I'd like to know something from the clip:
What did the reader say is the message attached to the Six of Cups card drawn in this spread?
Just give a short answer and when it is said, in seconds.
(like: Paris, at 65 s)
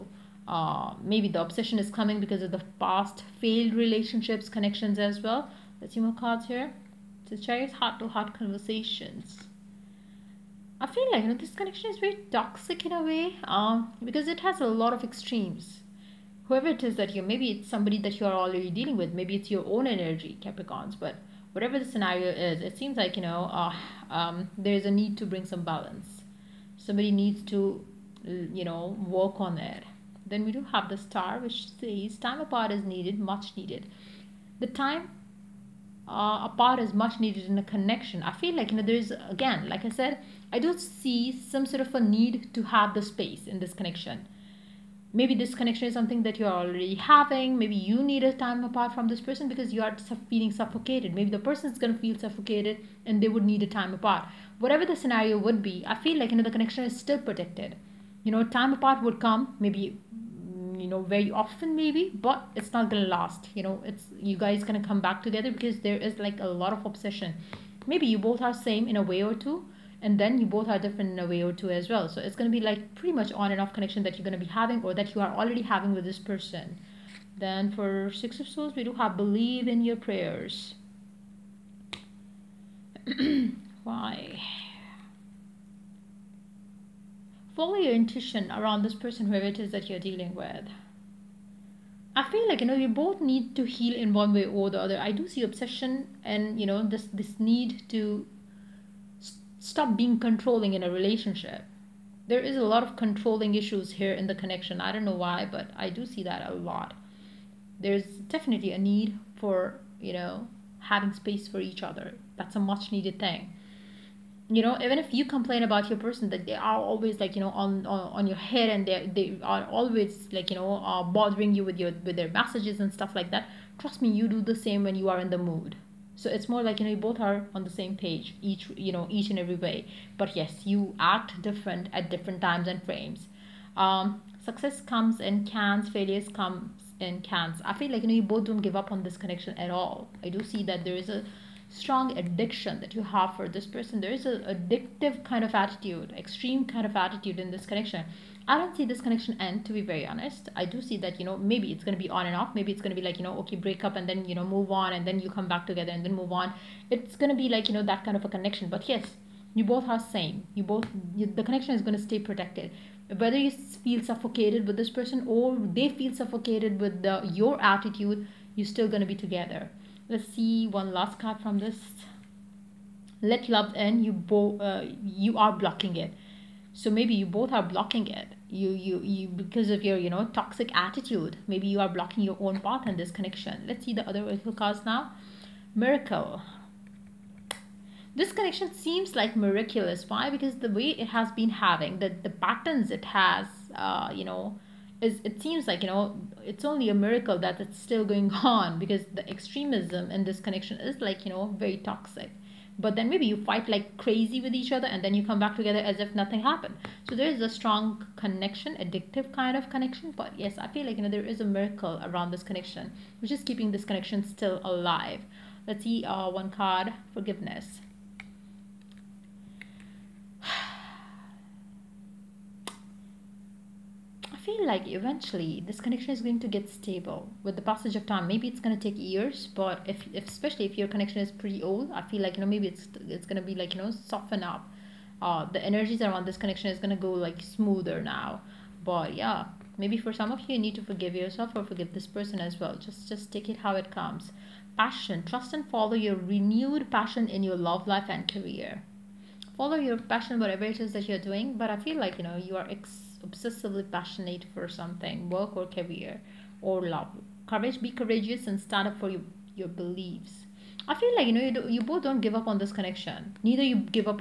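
Believe in your prayers, at 79 s.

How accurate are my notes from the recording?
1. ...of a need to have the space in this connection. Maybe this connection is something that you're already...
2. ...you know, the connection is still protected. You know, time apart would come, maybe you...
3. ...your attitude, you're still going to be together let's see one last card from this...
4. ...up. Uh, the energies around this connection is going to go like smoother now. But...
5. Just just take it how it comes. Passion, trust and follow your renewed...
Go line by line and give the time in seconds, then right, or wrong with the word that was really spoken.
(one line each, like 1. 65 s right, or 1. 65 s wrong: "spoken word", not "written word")
1. 41 s right
2. 56 s right
3. 167 s right
4. 234 s right
5. 242 s right.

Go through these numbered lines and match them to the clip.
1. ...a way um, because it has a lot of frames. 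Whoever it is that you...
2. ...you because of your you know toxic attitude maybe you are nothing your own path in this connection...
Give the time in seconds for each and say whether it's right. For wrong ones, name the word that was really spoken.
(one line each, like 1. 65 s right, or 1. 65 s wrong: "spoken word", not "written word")
1. 12 s wrong: "extremes", not "frames"
2. 179 s wrong: "blocking", not "nothing".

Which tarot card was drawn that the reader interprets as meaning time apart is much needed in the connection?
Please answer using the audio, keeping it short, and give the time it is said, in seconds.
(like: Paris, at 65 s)
The Star, at 30 s.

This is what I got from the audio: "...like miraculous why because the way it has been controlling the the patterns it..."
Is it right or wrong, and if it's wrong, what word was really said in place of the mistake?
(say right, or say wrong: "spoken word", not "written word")
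wrong: "having", not "controlling".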